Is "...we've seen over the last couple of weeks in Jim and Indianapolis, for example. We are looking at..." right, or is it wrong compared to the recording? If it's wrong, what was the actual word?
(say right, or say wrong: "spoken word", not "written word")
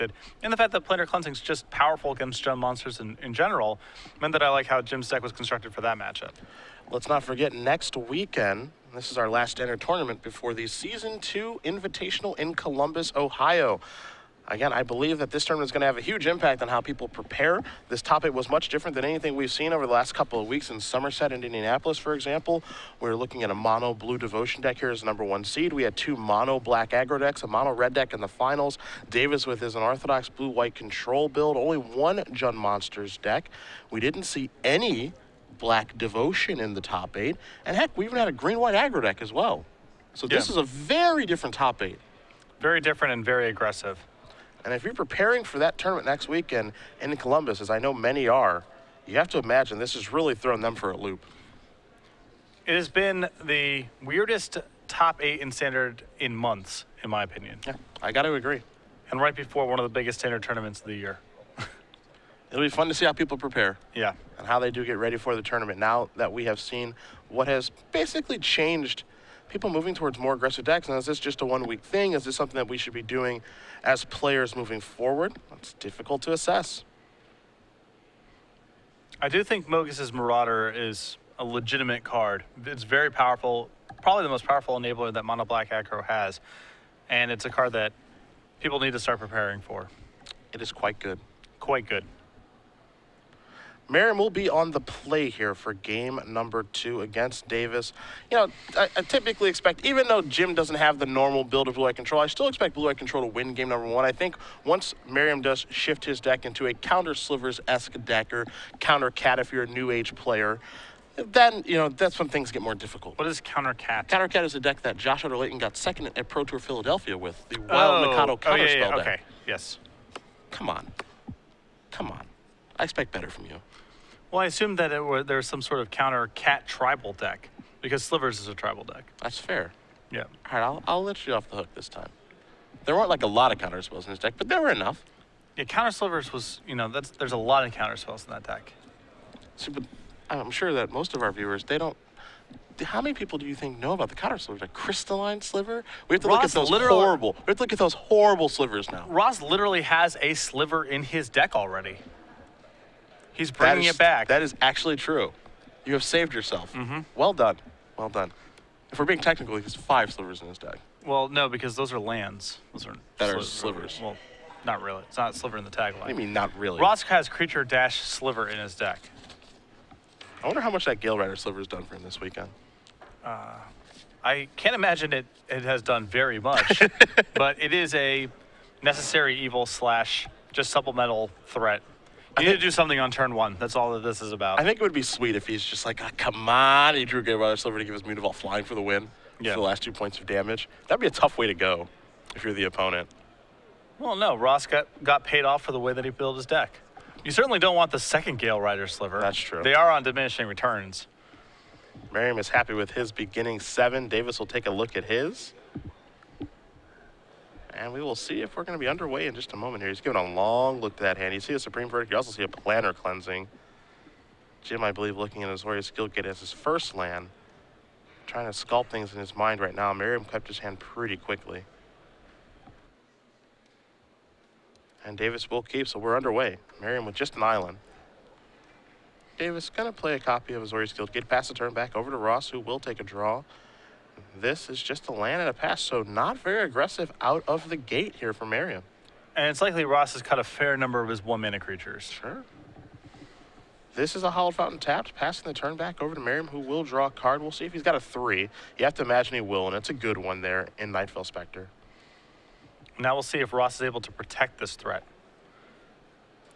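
wrong: "Somerset", not "Jim".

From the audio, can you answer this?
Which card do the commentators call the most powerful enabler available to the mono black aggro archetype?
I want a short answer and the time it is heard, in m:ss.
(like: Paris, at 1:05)
Mogis's Marauder, at 1:19.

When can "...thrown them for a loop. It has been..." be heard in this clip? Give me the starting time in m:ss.
0:50.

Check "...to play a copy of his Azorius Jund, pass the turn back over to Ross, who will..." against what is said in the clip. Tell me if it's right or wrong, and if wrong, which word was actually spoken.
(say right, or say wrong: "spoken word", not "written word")
wrong: "Guildgate", not "Jund".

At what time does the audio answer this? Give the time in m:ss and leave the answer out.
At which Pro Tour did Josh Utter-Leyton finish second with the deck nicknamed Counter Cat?
1:56.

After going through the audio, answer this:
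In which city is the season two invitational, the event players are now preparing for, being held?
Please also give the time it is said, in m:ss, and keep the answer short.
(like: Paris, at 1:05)
Columbus, Ohio, at 0:12.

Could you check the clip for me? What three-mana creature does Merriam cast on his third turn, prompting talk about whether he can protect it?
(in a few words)
Nightveil Specter.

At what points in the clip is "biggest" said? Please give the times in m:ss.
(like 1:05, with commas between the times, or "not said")
0:59.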